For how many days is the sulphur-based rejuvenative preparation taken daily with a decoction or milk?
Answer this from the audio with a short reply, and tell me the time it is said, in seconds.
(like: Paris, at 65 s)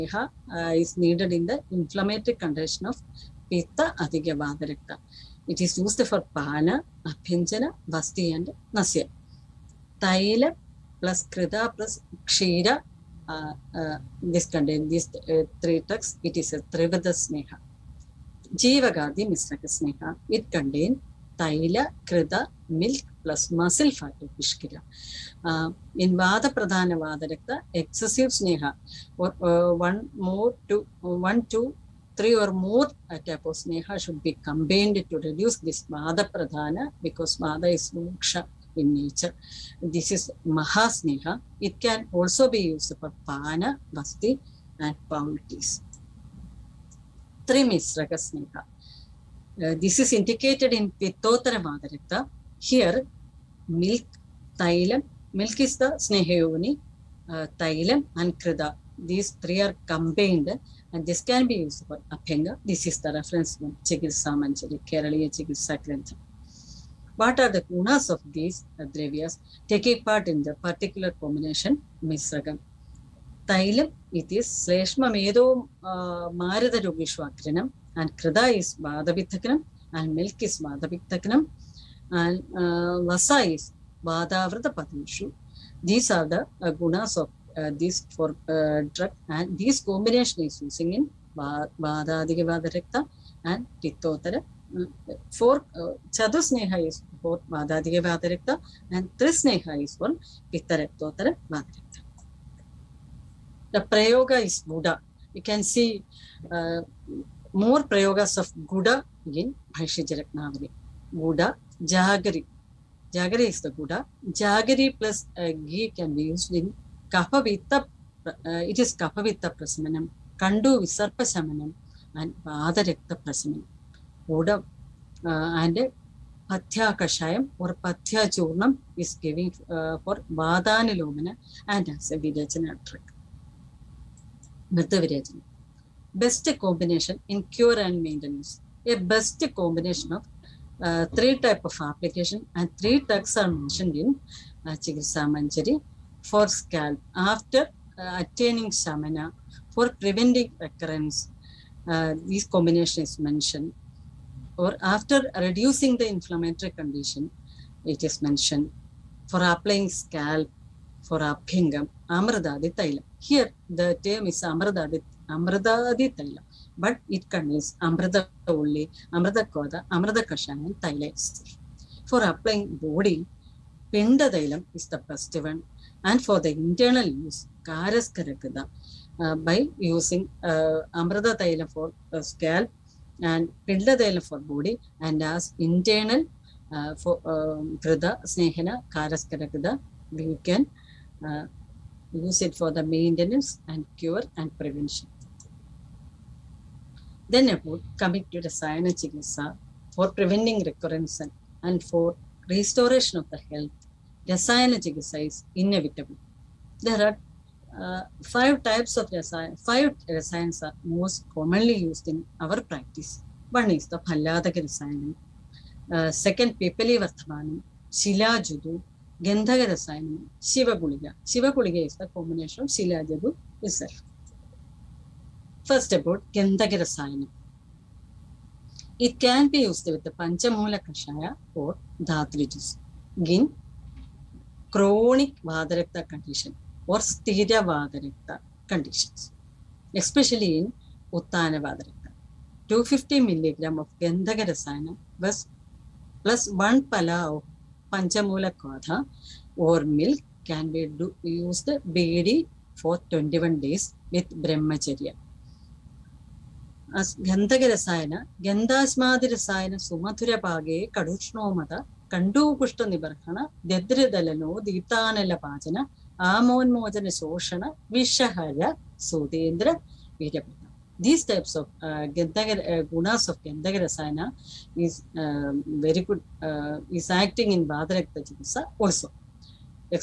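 21, at 253 s.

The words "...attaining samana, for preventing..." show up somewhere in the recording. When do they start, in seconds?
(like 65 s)
148 s.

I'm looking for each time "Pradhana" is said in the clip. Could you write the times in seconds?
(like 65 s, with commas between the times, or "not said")
26 s, 36 s.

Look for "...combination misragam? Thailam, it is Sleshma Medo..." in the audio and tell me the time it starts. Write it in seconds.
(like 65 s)
71 s.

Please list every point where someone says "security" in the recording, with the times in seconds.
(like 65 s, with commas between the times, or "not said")
not said.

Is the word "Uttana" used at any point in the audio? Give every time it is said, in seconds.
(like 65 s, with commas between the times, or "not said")
241 s.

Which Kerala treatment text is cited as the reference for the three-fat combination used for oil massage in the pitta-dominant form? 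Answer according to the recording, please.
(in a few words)
Chikitsa Manjari.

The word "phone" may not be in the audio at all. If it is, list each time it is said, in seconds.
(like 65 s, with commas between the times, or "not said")
not said.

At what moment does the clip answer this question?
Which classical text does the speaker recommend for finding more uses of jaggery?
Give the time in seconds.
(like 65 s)
109 s.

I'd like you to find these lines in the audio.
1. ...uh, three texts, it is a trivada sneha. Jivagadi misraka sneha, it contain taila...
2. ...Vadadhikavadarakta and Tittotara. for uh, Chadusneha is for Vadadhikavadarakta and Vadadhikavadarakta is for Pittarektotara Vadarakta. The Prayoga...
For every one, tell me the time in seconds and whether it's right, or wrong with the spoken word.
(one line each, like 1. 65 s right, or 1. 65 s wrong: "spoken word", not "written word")
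1. 15 s right
2. 91 s wrong: "Trisneha", not "Vadadhikavadarakta".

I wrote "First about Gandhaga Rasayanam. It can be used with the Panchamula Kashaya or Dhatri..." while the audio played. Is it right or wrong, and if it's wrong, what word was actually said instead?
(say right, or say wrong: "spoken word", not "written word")
right.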